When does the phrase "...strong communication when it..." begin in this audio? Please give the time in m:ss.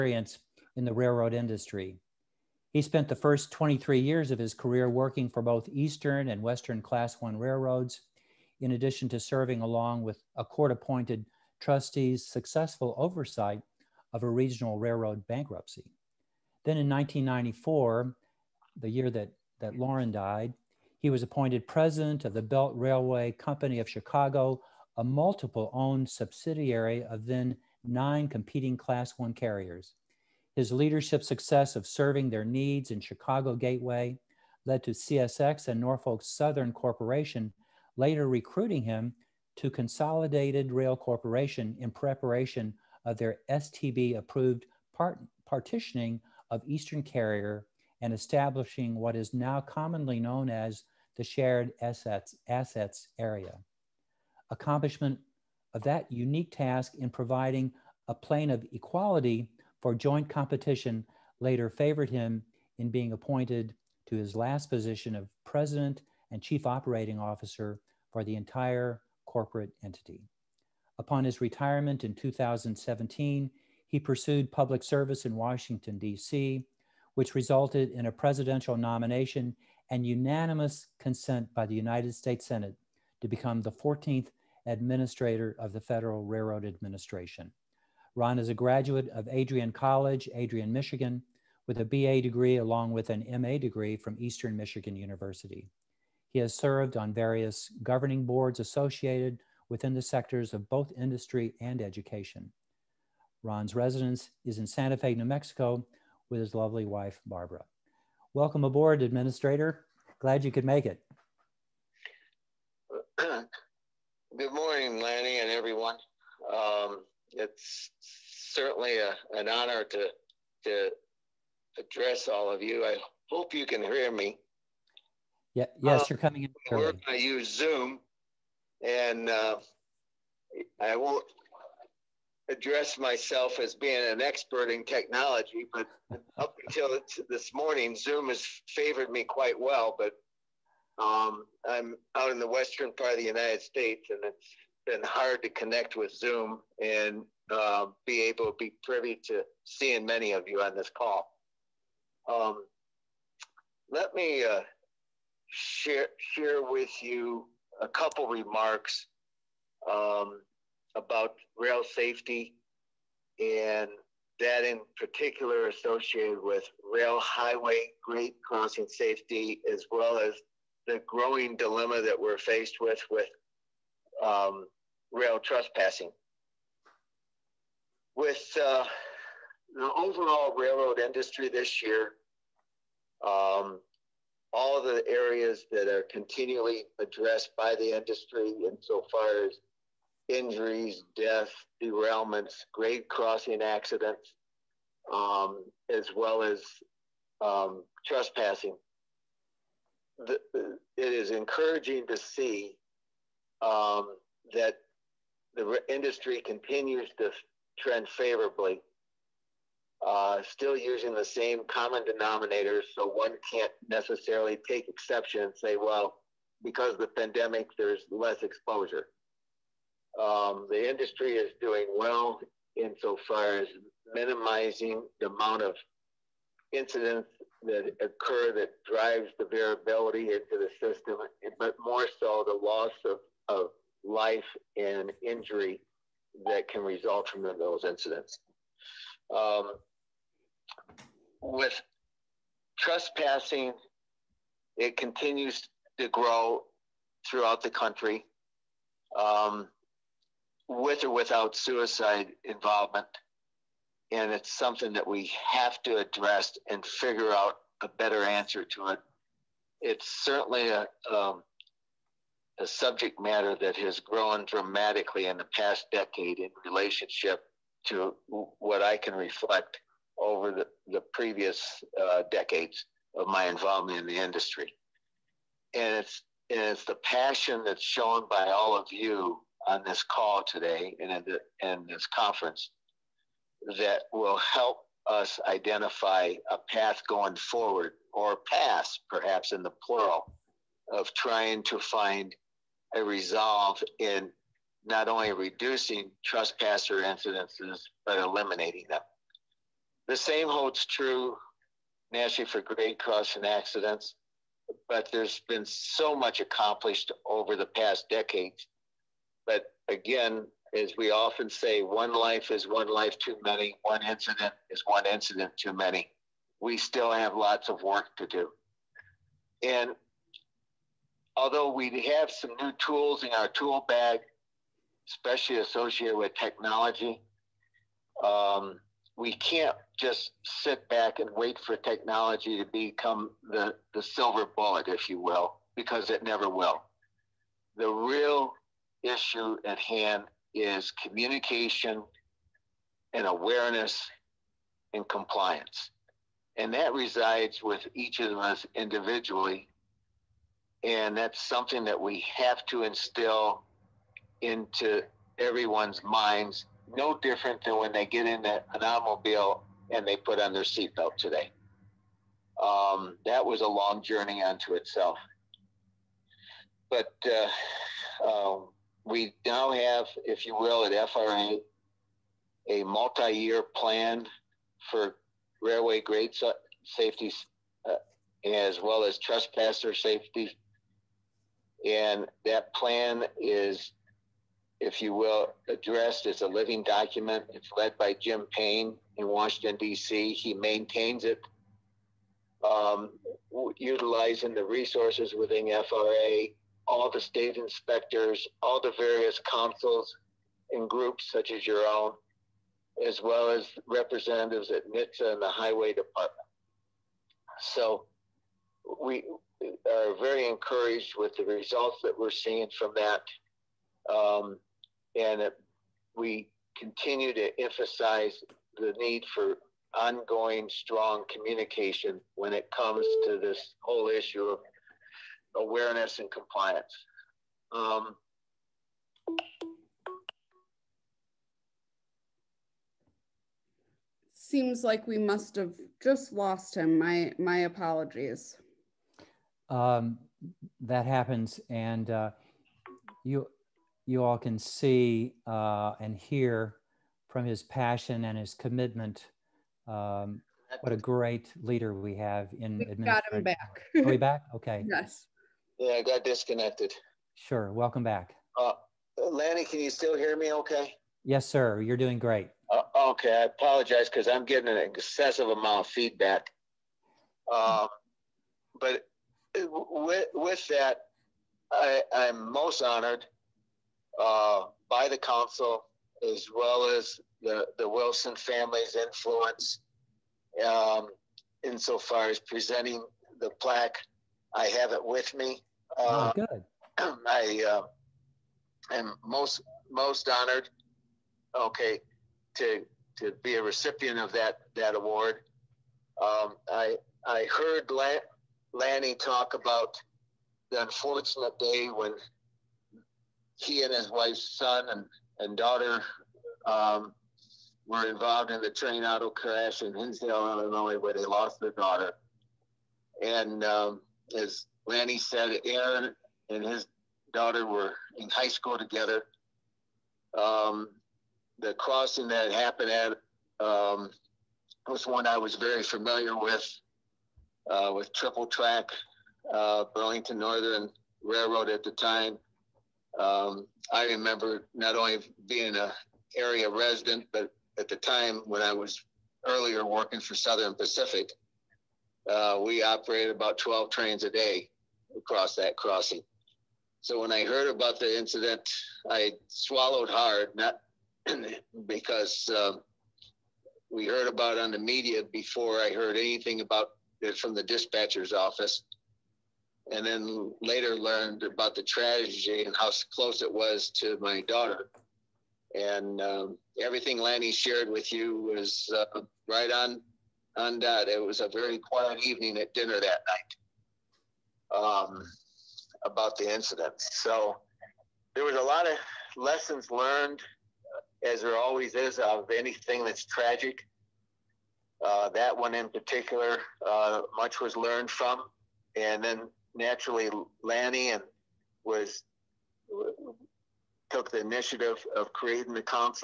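7:00.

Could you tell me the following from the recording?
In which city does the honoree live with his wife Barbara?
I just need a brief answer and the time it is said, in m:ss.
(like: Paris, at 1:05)
Santa Fe, at 1:44.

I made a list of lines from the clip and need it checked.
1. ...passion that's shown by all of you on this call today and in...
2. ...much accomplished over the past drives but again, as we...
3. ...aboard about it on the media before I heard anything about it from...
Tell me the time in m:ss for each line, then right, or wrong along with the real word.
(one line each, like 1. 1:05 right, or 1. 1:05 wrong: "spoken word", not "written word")
1. 4:37 right
2. 5:06 wrong: "decades", not "drives"
3. 9:14 wrong: "heard", not "aboard".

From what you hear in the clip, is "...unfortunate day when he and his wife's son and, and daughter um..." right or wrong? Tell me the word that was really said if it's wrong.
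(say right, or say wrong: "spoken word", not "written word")
right.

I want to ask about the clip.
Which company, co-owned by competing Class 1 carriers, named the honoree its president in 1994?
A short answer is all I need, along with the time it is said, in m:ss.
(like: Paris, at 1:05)
Belt Railway Company of Chicago, at 0:22.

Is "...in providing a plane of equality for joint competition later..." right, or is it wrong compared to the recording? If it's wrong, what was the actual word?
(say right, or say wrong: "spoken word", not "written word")
right.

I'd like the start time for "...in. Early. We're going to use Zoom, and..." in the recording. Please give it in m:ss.
2:06.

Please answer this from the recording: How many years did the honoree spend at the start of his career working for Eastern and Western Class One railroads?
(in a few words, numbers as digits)
23.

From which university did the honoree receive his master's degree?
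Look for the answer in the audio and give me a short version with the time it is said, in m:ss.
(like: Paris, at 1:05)
Eastern Michigan University, at 1:34.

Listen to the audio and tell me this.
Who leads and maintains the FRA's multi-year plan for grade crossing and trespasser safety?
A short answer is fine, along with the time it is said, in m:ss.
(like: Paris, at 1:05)
Jim Payne, at 6:28.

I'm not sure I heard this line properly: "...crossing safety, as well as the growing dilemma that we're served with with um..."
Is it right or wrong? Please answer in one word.
wrong.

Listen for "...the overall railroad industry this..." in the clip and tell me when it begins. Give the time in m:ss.
2:59.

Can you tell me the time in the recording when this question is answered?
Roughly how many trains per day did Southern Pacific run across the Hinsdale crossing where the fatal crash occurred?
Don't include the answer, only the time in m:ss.
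9:03.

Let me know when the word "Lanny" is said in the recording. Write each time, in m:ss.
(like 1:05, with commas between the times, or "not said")
1:55, 7:39, 8:18, 8:34, 9:27, 9:50.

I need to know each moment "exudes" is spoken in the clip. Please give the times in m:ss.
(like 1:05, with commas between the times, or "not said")
not said.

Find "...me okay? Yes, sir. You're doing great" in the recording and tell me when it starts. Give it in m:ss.
7:40.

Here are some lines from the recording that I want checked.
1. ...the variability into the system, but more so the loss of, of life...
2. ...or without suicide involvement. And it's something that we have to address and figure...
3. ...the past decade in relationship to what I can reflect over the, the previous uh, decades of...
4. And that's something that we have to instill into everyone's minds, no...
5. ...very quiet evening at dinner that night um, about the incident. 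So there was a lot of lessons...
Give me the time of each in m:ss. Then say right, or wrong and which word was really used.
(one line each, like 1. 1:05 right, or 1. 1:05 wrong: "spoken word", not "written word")
1. 3:49 right
2. 4:11 right
3. 4:25 right
4. 5:50 right
5. 9:31 right.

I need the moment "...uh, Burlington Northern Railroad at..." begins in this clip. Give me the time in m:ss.
8:49.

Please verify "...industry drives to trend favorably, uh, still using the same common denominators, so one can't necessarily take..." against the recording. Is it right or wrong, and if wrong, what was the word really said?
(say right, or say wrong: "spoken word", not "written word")
wrong: "continues", not "drives".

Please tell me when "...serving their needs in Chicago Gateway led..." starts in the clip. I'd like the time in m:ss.
0:31.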